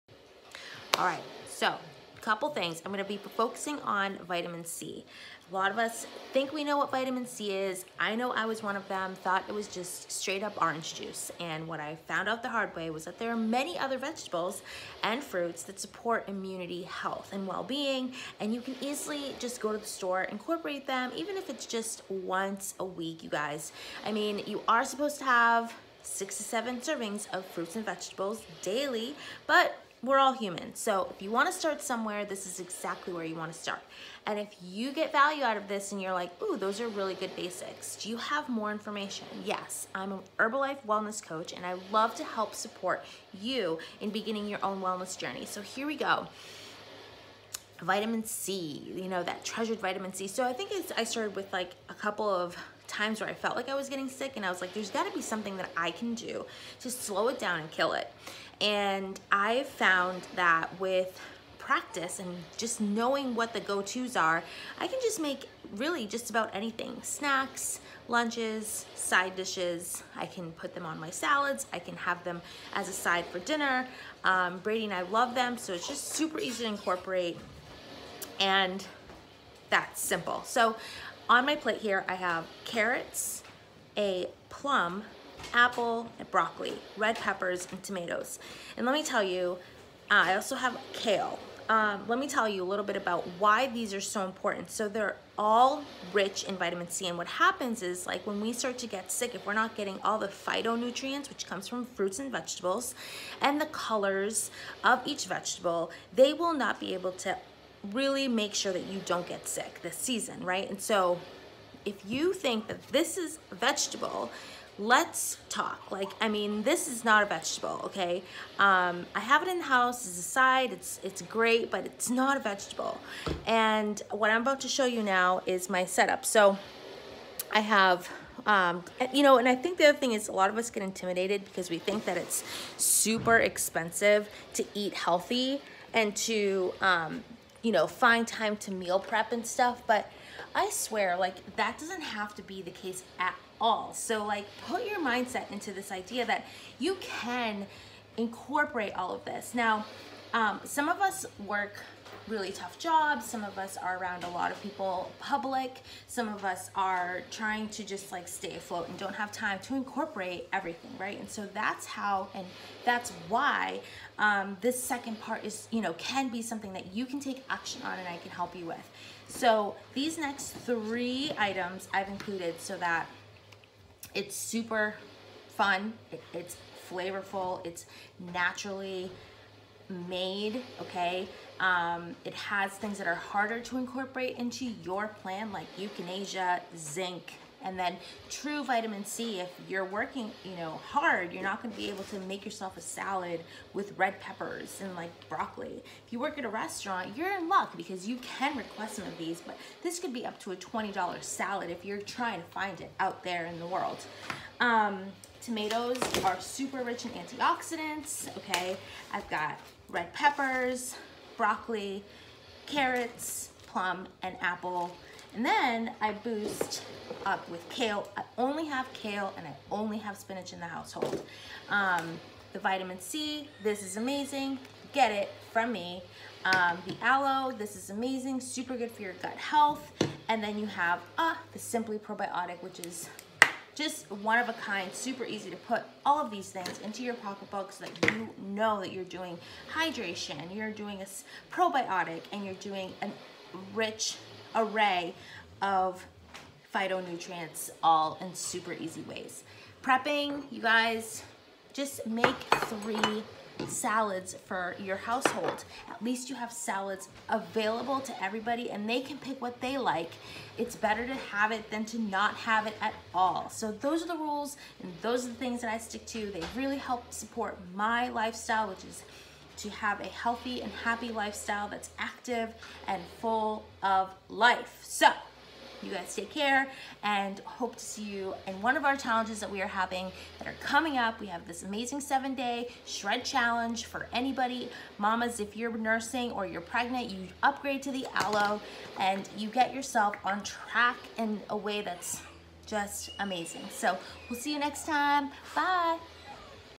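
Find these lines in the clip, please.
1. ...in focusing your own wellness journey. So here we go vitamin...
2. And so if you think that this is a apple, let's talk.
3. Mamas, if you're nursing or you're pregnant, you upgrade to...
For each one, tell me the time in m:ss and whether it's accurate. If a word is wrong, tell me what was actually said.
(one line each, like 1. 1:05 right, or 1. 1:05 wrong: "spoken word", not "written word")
1. 0:43 wrong: "beginning", not "focusing"
2. 1:50 wrong: "vegetable", not "apple"
3. 4:44 right.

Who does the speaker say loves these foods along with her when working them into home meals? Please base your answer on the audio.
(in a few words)
Brady.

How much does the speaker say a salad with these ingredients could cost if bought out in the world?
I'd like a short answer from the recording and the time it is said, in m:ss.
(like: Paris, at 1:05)
$20, at 3:20.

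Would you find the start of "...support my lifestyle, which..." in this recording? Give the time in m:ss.
4:27.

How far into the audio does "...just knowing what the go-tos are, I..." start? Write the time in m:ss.
1:02.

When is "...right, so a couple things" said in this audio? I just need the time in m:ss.
0:01.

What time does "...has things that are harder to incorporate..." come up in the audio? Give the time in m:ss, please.
3:02.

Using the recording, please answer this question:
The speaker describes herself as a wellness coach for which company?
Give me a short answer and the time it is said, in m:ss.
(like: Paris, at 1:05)
Herbalife, at 0:40.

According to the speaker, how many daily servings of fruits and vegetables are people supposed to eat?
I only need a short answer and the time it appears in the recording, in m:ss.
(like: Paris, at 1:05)
6 to 7, at 0:26.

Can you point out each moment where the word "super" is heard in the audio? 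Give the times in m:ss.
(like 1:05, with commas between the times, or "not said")
1:16, 2:12, 2:54, 3:26, 3:48, 3:54, 4:08.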